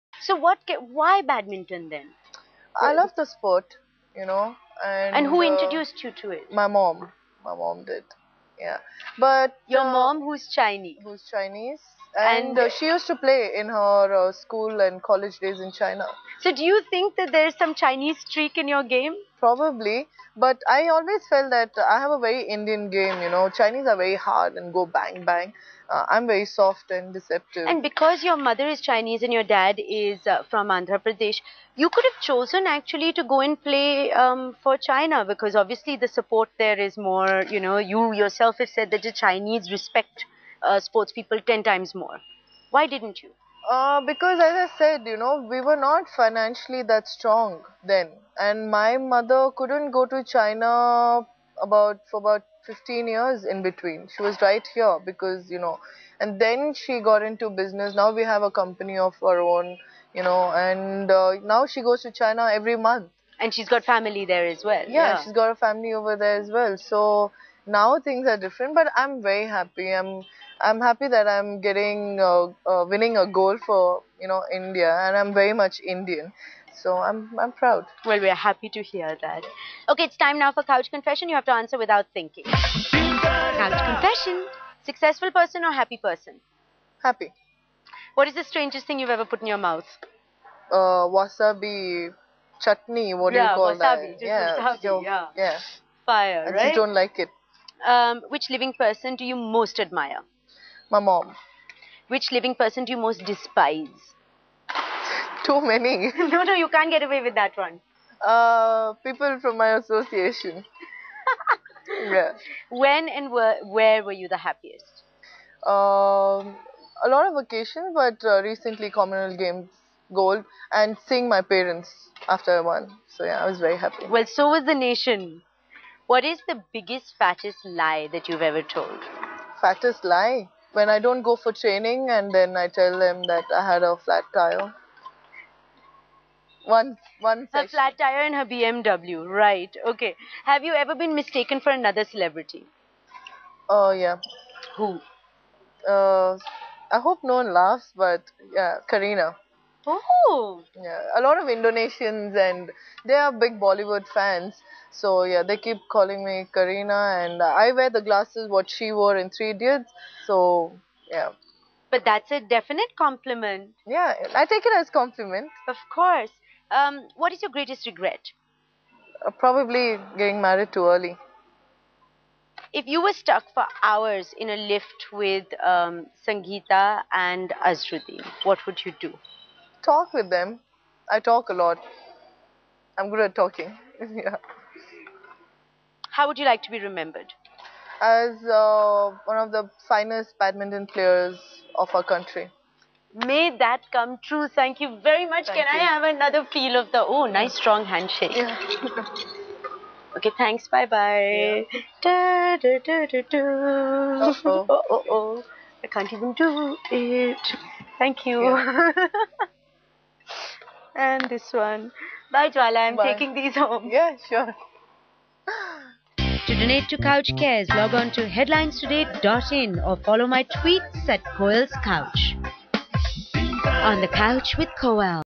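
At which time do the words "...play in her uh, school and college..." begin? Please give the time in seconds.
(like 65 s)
13 s.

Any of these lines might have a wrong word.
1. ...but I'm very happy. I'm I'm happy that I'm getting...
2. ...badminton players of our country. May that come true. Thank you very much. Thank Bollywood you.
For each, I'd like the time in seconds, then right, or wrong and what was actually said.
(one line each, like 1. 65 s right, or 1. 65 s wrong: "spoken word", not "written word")
1. 68 s right
2. 190 s wrong: "Can", not "Bollywood".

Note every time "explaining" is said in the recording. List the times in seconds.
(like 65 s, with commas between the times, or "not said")
not said.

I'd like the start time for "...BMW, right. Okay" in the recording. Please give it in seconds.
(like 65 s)
138 s.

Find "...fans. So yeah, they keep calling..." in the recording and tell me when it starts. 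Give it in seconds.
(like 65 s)
154 s.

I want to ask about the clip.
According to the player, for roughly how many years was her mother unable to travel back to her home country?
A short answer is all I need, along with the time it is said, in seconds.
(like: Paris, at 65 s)
15 years, at 52 s.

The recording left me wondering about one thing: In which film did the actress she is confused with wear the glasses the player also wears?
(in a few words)
Three Idiots.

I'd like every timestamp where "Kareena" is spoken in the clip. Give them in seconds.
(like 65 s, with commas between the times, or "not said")
148 s, 156 s.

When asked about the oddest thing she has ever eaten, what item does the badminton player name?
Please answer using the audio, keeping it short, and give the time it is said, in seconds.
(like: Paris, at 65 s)
Wasabi chutney, at 91 s.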